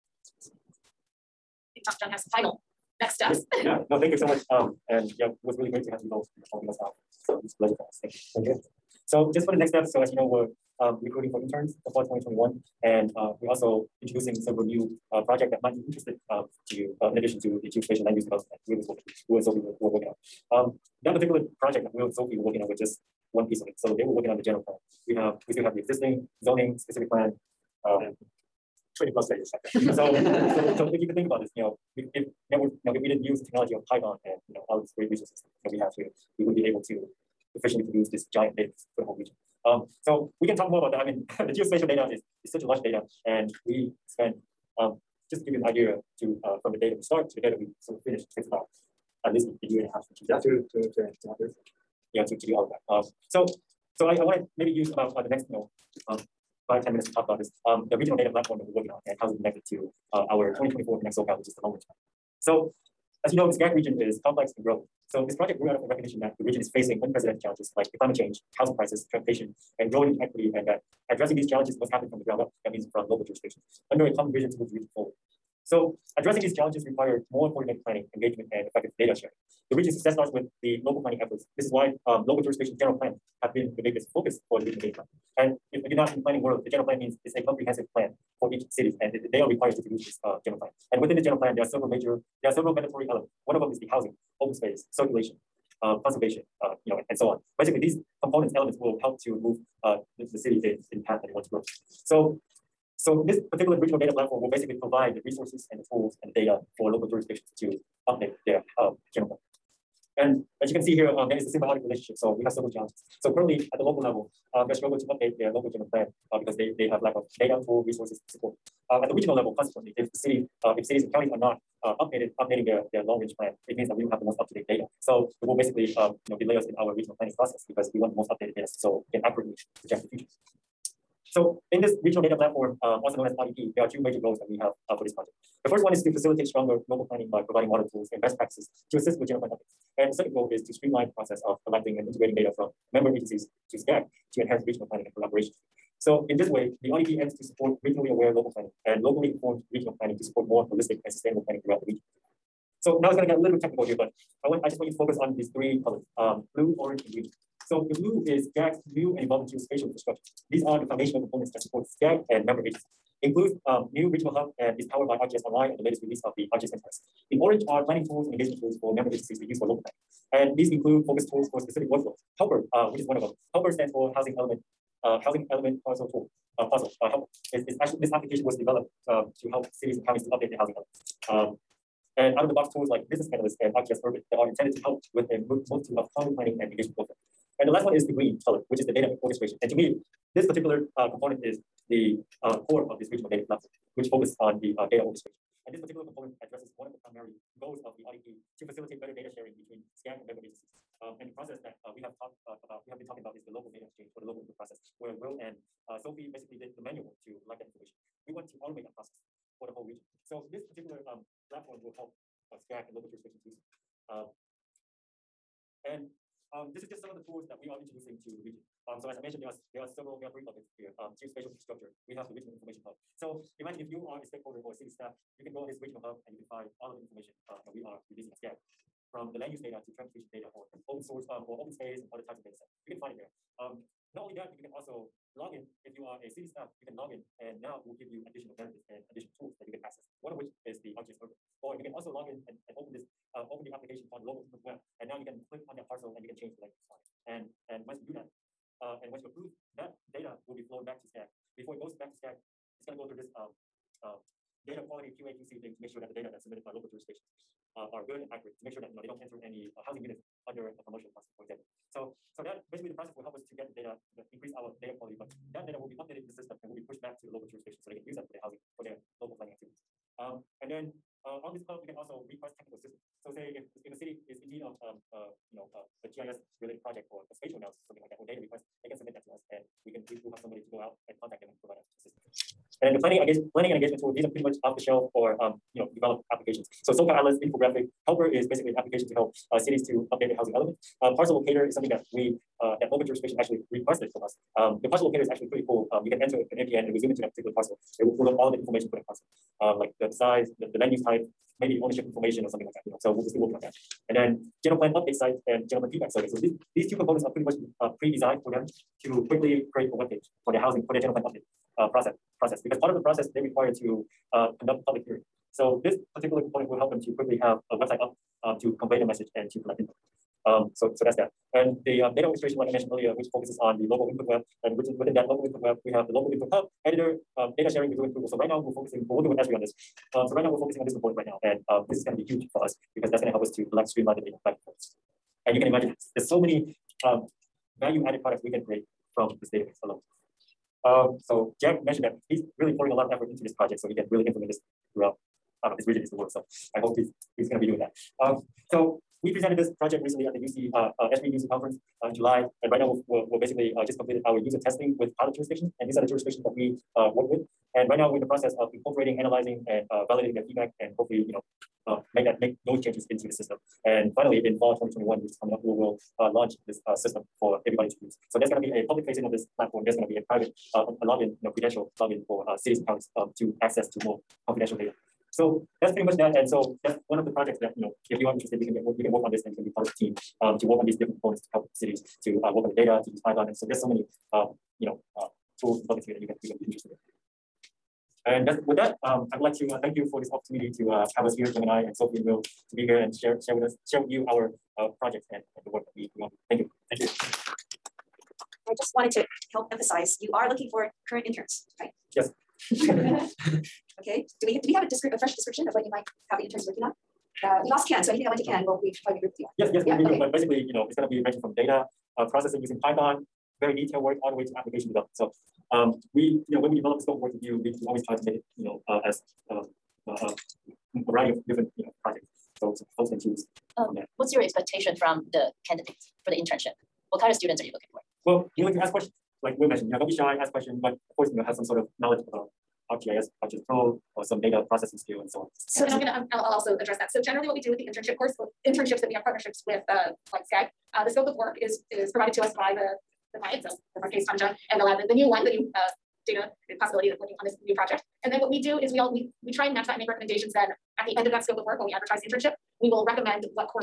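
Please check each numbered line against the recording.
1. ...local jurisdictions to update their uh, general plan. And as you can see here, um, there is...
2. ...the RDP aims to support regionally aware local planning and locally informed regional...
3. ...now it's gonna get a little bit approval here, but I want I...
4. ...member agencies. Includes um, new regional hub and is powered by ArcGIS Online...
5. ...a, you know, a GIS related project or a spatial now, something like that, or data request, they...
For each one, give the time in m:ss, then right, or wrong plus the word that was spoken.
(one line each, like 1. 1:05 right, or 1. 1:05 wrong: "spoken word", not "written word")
1. 1:46 right
2. 2:26 right
3. 2:33 wrong: "technical", not "approval"
4. 2:42 right
5. 4:34 right.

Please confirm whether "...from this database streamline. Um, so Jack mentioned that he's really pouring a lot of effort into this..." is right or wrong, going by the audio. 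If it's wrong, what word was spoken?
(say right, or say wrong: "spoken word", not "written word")
wrong: "alone", not "streamline".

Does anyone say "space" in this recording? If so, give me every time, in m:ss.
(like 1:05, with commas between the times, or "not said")
1:34, 3:51.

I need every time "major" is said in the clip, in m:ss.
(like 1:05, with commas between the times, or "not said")
1:31, 2:13.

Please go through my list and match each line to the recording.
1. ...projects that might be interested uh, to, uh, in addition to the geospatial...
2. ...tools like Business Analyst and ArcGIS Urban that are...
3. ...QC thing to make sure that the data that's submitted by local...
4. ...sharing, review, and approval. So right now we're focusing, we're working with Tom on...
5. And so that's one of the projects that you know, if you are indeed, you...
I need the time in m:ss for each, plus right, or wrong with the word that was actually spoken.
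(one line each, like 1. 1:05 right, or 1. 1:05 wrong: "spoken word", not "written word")
1. 0:15 right
2. 3:02 right
3. 4:15 right
4. 5:27 wrong: "Esri", not "Tom"
5. 6:16 wrong: "interested", not "indeed".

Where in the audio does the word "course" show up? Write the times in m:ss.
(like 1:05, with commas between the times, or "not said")
7:11, 7:18.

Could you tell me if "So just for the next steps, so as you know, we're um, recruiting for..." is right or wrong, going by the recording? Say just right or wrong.
right.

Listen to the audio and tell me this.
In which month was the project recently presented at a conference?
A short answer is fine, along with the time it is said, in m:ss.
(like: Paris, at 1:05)
July, at 5:52.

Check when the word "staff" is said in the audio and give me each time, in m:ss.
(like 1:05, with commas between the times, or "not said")
3:44, 3:56.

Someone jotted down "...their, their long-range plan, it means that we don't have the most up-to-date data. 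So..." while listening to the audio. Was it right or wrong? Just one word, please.
right.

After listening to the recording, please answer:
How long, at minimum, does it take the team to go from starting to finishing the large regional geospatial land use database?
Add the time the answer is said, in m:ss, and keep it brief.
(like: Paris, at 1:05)
a year and a half, at 0:49.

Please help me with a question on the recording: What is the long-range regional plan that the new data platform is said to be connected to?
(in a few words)
2024 Connect SoCal.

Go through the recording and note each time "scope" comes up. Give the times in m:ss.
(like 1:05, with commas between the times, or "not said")
6:57, 7:21, 7:31.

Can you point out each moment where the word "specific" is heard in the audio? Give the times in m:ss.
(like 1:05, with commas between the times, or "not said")
0:26, 2:51.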